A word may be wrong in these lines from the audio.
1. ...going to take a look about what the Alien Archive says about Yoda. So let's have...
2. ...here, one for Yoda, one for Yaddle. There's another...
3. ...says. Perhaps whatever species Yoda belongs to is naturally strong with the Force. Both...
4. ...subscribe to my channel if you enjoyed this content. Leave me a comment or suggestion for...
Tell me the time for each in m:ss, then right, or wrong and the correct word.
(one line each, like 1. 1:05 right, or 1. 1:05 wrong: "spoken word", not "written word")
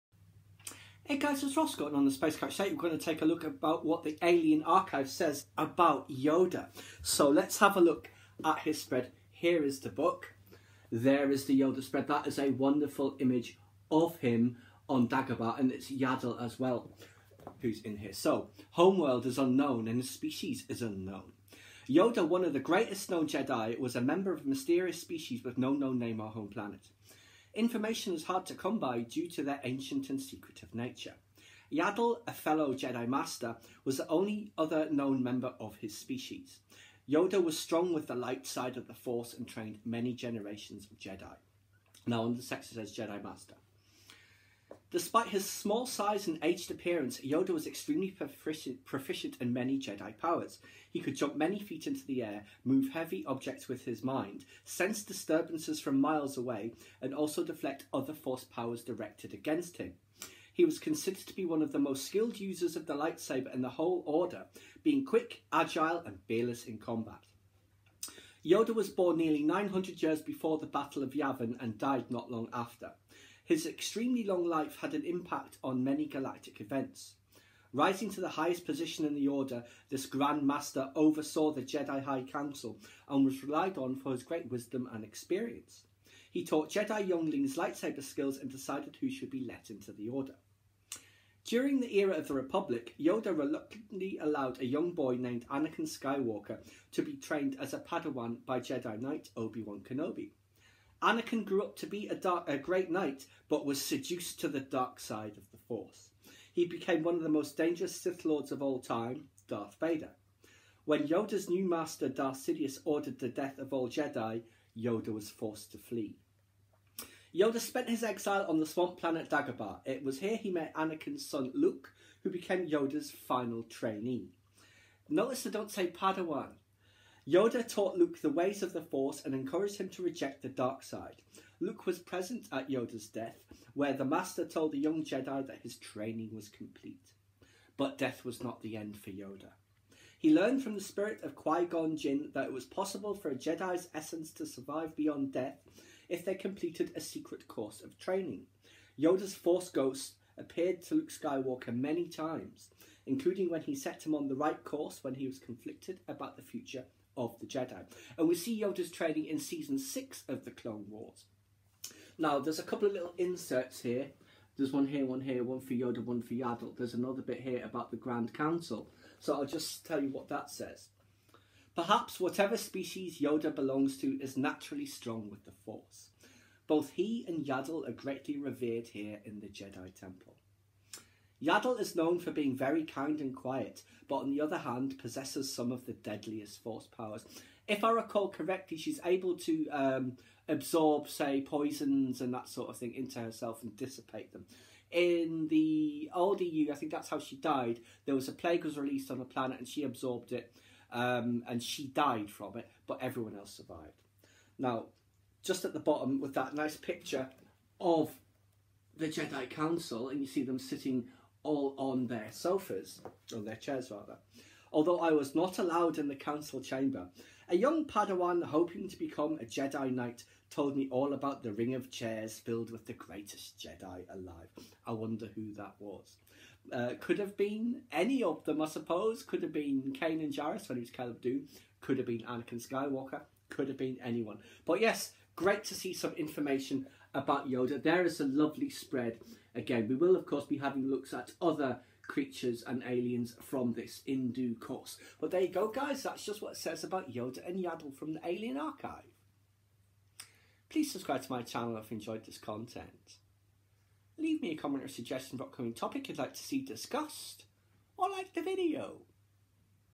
1. 0:02 right
2. 2:45 right
3. 2:50 right
4. 4:10 right.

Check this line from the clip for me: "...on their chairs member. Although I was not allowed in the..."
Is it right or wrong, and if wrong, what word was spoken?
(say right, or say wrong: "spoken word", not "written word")
wrong: "rather", not "member".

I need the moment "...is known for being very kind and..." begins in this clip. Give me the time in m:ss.
3:01.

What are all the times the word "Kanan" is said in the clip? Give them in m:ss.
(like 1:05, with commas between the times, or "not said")
3:49.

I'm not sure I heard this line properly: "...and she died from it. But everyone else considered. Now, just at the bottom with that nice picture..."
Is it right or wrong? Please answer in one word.
wrong.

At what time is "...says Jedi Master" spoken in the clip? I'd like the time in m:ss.
0:42.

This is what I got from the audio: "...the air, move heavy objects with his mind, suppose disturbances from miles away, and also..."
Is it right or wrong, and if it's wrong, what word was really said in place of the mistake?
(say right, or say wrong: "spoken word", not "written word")
wrong: "sense", not "suppose".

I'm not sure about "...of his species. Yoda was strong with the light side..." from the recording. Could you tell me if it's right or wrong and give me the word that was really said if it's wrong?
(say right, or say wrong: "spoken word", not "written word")
right.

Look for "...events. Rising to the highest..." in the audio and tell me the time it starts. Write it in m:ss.
1:16.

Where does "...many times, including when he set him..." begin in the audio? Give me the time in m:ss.
2:31.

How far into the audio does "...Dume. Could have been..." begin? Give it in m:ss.
3:51.